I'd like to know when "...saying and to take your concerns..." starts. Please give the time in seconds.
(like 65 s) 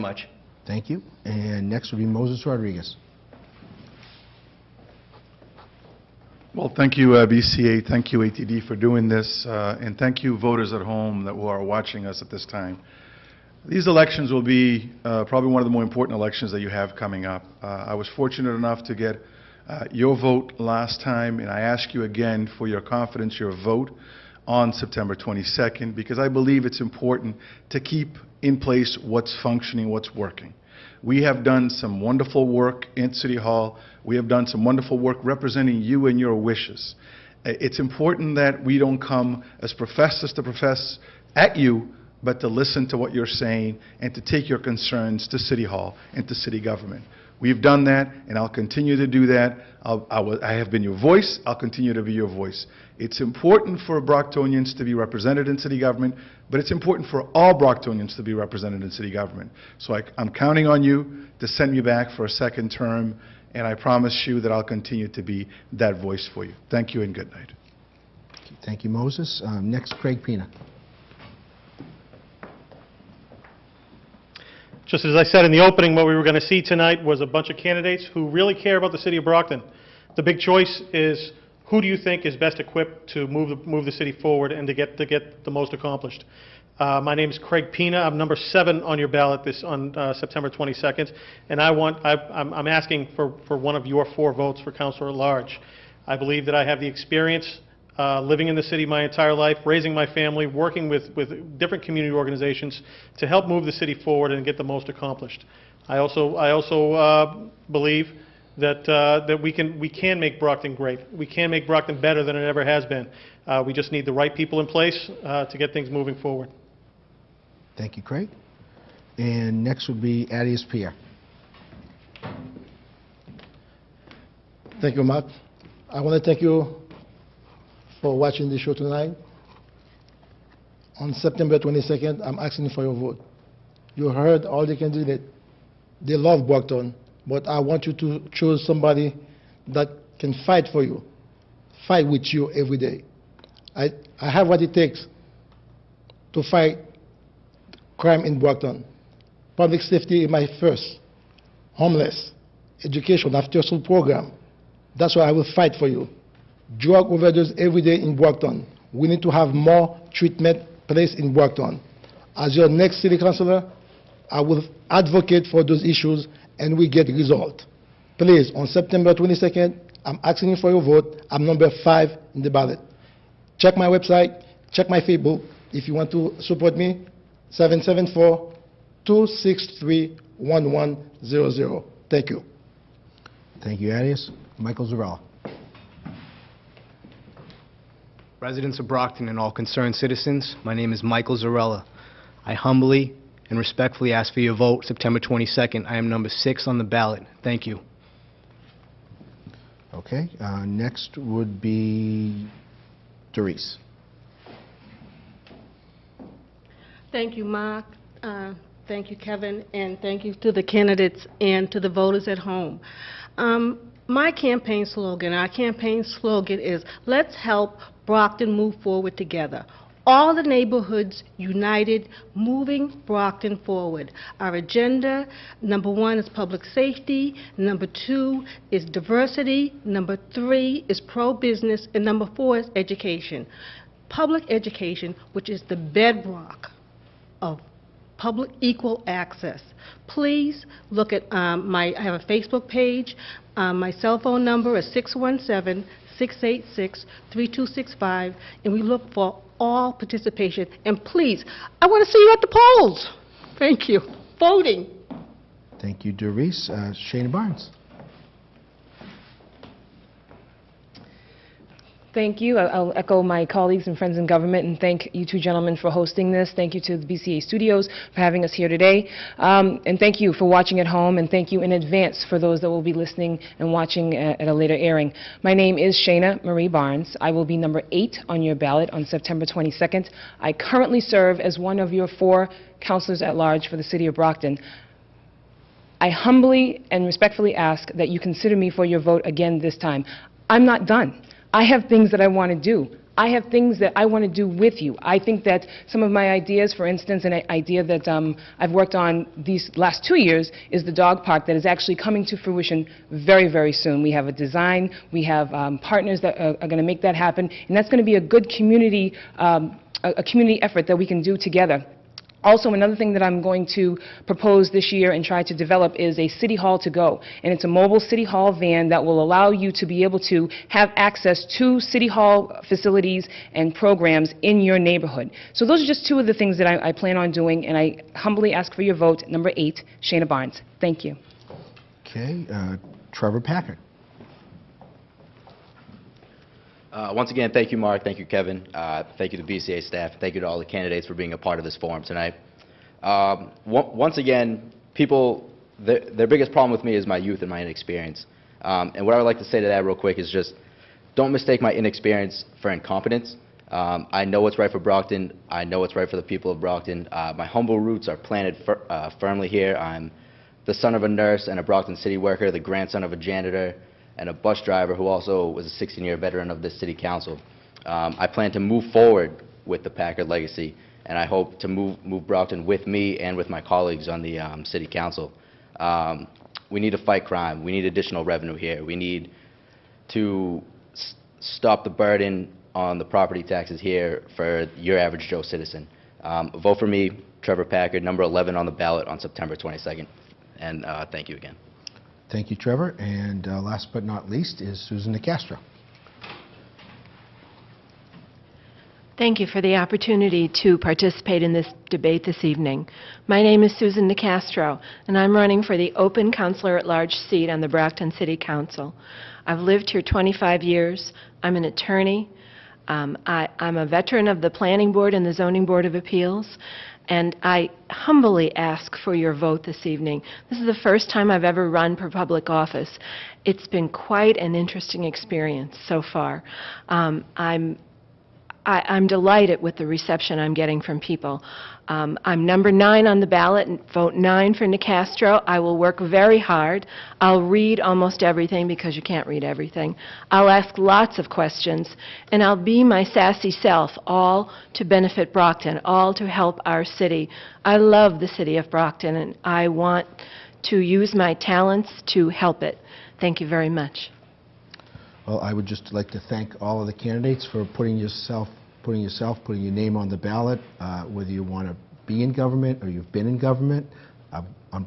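43 s.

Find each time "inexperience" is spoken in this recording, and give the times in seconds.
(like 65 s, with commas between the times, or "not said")
347 s, 351 s.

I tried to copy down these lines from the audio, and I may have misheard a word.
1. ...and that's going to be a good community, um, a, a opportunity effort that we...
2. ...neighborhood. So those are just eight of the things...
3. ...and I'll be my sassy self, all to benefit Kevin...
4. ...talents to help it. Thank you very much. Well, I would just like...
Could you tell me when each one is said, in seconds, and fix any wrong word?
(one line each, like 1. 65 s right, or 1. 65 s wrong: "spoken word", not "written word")
1. 307 s wrong: "community", not "opportunity"
2. 324 s wrong: "two", not "eight"
3. 442 s wrong: "Brockton", not "Kevin"
4. 451 s right.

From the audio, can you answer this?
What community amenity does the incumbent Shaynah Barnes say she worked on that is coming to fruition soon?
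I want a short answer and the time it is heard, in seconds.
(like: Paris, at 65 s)
dog park, at 300 s.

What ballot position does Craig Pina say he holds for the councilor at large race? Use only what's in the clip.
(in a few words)
7.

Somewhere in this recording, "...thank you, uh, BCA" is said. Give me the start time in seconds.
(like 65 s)
6 s.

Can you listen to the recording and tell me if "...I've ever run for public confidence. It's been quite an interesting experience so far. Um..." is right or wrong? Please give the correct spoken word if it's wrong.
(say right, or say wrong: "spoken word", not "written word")
wrong: "office", not "confidence".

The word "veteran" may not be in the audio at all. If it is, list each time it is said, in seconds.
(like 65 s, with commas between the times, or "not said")
366 s, 413 s.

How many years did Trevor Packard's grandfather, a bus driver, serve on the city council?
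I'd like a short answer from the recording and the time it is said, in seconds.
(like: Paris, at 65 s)
16, at 365 s.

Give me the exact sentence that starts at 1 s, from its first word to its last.
And next will be Moses Rodrigues.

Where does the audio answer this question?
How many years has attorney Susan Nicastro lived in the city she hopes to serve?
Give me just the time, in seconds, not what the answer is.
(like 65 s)
410 s.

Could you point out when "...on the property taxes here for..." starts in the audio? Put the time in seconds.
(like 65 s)
382 s.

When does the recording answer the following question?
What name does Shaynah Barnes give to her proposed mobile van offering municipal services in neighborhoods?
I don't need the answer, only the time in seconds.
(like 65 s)
316 s.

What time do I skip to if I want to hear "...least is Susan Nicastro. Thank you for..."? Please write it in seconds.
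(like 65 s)
394 s.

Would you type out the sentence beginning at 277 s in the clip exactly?
I will be number eight on your ballot on September 22nd.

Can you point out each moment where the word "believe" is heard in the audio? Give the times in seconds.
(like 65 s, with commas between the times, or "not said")
26 s, 96 s, 107 s.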